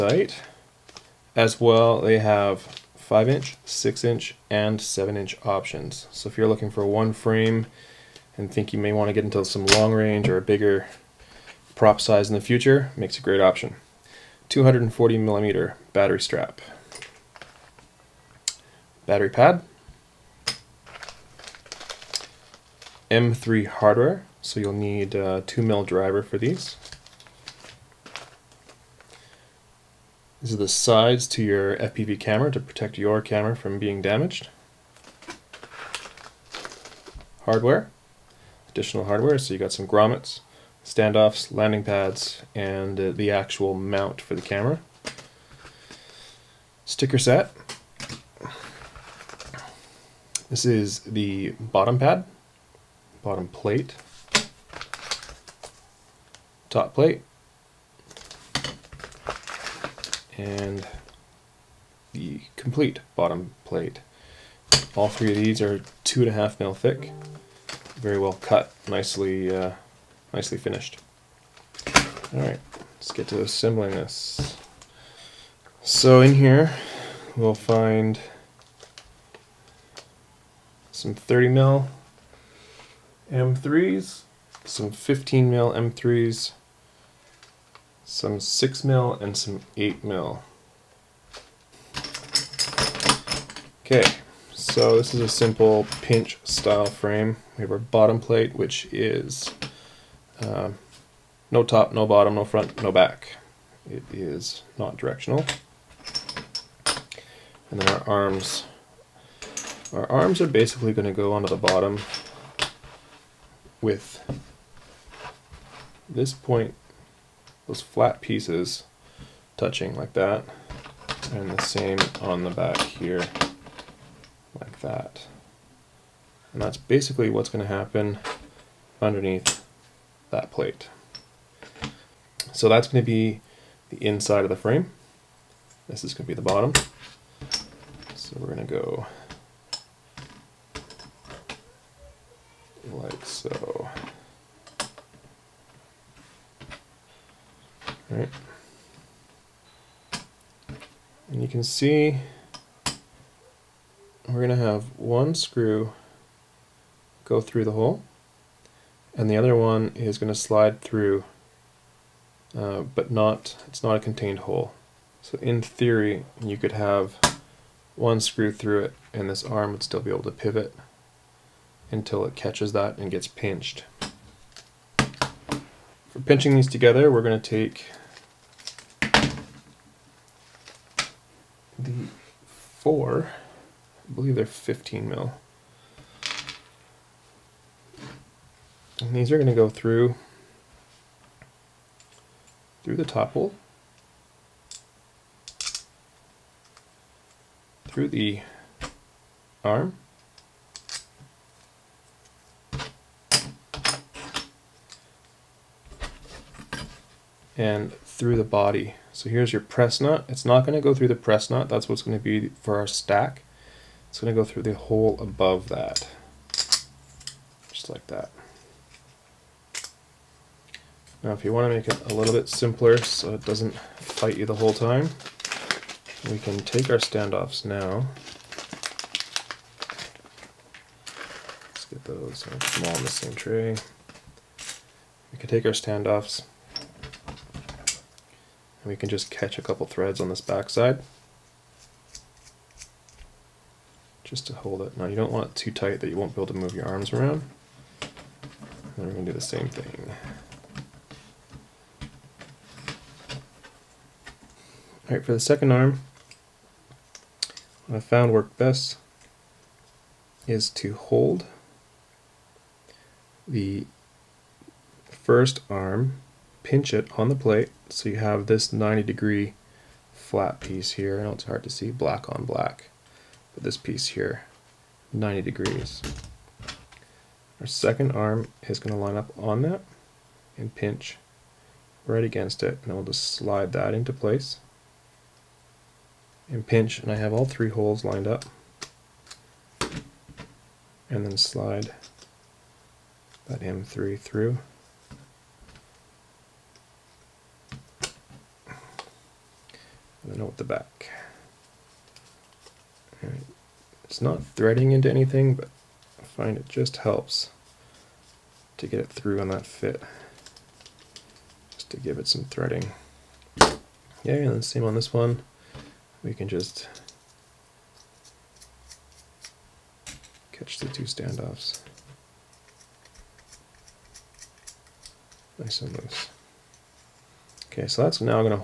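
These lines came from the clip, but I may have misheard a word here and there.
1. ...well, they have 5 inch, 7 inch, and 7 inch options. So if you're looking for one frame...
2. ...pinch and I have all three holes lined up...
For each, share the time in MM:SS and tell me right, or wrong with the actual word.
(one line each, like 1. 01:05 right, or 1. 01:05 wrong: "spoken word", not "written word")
1. 00:01 wrong: "6", not "7"
2. 04:46 right.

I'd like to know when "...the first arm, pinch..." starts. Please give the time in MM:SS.
04:23.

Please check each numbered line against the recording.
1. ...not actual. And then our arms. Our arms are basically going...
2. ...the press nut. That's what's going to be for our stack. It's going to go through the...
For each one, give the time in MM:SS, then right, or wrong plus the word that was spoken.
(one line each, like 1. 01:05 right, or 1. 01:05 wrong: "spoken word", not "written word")
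1. 01:44 wrong: "directional", not "actual"
2. 03:31 right.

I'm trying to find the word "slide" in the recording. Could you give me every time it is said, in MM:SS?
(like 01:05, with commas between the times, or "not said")
02:40, 04:43, 04:51.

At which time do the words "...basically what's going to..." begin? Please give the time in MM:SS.
02:06.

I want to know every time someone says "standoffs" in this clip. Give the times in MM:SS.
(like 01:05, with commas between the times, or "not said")
00:40, 03:46, 03:55, 05:21.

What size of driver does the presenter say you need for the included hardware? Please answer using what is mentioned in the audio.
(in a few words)
2 mil.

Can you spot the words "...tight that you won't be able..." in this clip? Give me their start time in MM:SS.
04:05.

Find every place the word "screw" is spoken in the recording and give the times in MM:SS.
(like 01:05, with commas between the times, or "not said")
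02:35, 02:48.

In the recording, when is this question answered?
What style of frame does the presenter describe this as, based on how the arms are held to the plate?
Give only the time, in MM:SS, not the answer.
01:36.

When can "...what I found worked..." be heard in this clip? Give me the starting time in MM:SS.
04:17.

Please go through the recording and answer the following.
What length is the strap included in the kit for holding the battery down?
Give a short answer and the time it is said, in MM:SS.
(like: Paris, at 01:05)
240 millimeter, at 00:14.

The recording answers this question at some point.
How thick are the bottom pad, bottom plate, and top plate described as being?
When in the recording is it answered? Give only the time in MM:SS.
01:06.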